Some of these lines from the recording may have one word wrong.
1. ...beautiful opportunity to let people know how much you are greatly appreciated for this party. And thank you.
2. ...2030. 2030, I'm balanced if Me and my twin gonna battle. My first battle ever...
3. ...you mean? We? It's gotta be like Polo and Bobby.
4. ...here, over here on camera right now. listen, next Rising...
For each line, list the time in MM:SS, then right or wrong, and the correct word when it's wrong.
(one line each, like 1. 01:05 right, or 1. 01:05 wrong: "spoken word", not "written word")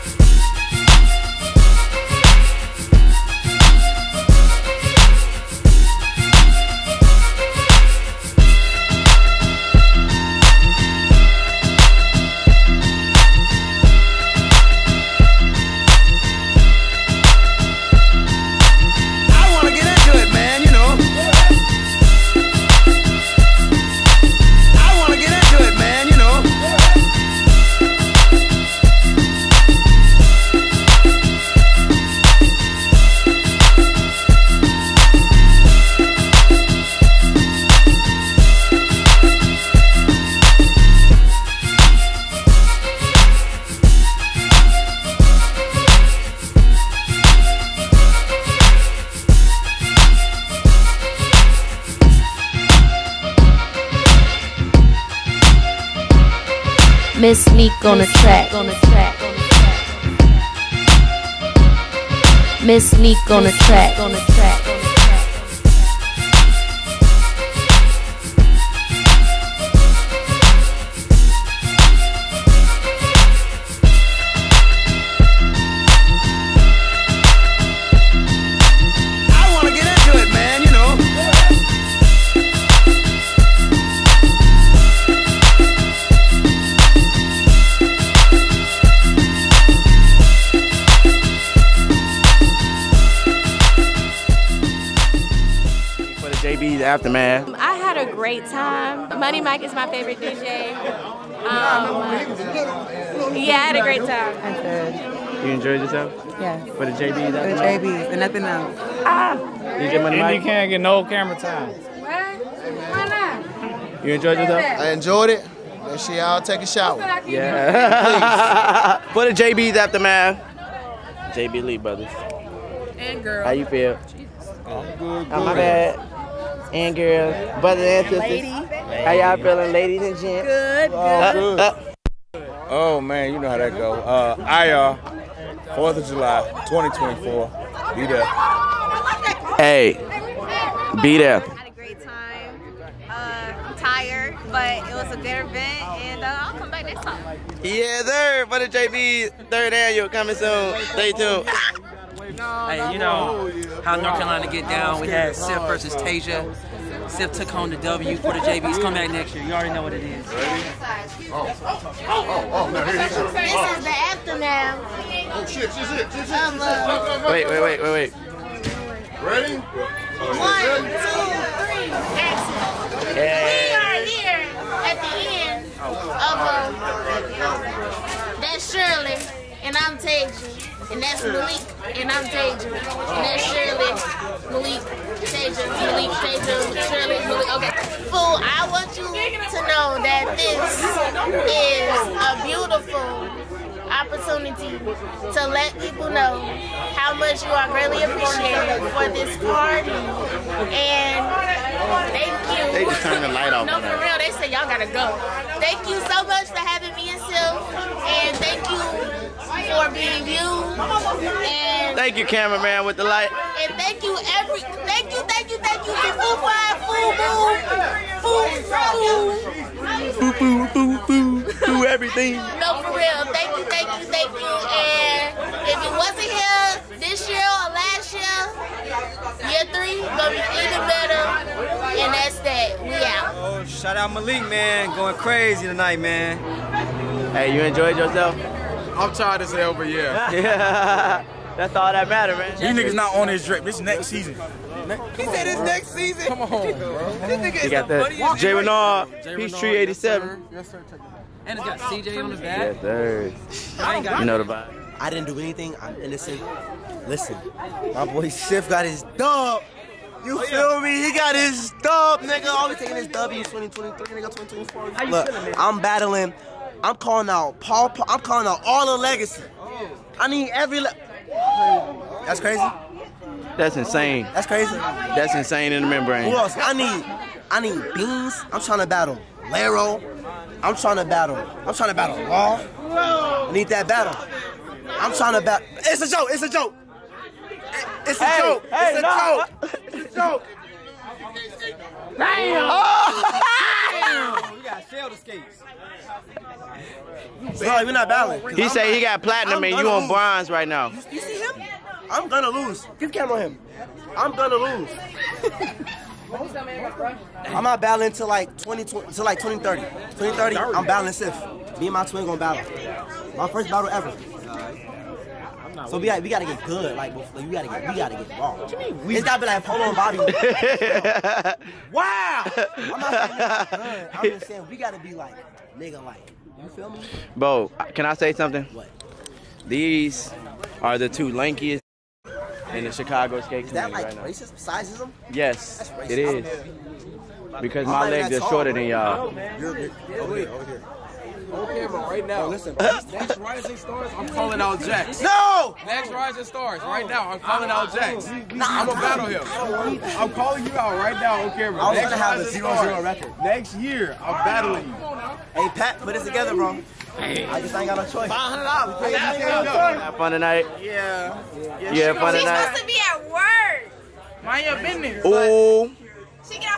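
1. 03:12 right
2. 05:09 right
3. 05:18 right
4. 05:40 right.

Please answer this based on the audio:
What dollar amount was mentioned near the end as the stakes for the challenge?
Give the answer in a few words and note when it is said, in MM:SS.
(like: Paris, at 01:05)
$500, at 05:58.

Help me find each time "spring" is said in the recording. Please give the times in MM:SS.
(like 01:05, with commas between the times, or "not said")
not said.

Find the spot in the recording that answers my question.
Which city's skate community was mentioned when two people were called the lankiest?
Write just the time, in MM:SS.
05:32.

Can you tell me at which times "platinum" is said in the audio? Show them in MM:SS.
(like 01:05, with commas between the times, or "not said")
04:59.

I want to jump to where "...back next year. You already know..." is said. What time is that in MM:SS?
02:38.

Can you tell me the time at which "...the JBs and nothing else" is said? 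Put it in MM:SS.
01:47.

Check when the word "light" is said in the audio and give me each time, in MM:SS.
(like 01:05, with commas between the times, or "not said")
03:23, 03:33.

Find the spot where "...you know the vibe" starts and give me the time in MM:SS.
04:14.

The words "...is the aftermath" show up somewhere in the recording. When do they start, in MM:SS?
02:43.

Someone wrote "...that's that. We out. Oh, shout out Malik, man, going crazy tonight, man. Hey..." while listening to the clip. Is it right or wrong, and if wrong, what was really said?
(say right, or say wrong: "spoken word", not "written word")
right.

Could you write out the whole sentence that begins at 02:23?
Uh, i tired, but it was a good event, and uh, I'll come back next time.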